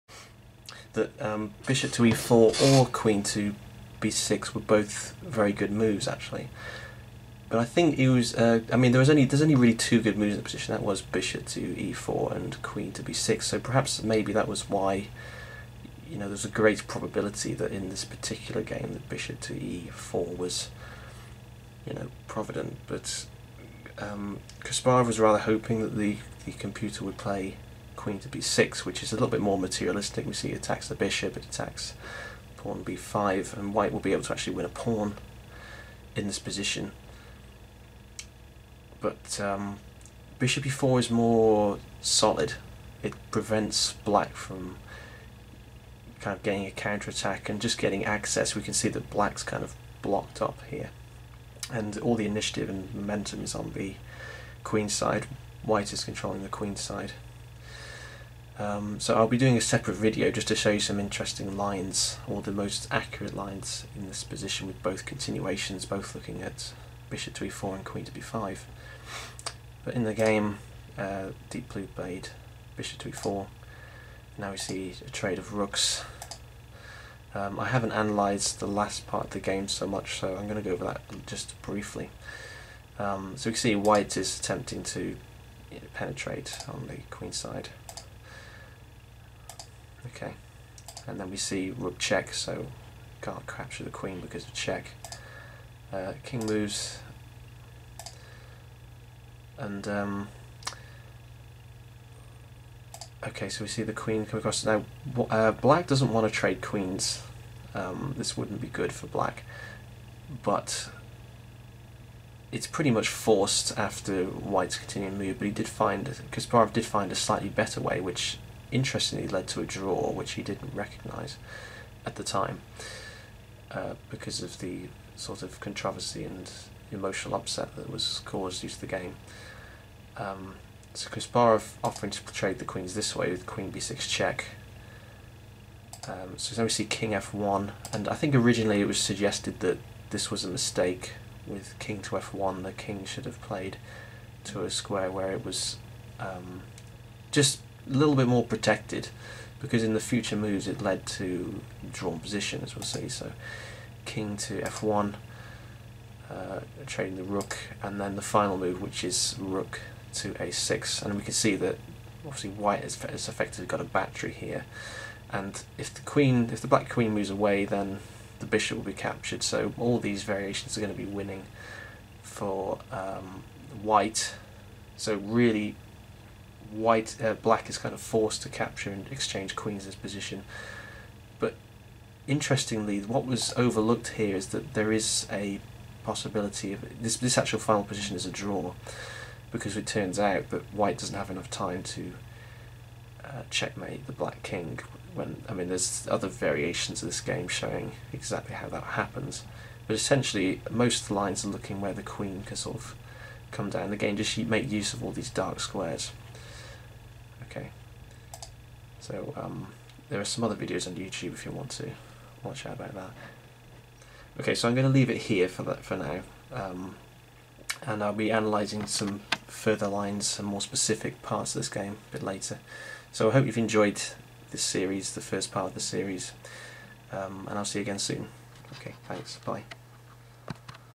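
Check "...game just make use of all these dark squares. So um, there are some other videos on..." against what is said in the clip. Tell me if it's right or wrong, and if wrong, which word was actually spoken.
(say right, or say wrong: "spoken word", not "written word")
right.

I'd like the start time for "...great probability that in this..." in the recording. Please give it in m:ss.
0:16.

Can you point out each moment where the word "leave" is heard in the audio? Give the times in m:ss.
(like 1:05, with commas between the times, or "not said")
3:34.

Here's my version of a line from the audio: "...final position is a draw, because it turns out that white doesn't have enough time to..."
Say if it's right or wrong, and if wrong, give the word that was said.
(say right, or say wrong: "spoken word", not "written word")
right.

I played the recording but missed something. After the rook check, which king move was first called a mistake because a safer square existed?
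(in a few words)
King f1.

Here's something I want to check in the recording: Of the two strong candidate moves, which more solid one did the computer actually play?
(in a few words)
Bishop to e4.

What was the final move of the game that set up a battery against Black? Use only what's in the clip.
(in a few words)
Rook to a6.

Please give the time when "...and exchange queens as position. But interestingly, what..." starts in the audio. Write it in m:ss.
2:58.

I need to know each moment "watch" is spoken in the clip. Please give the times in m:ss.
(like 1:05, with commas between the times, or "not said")
3:32.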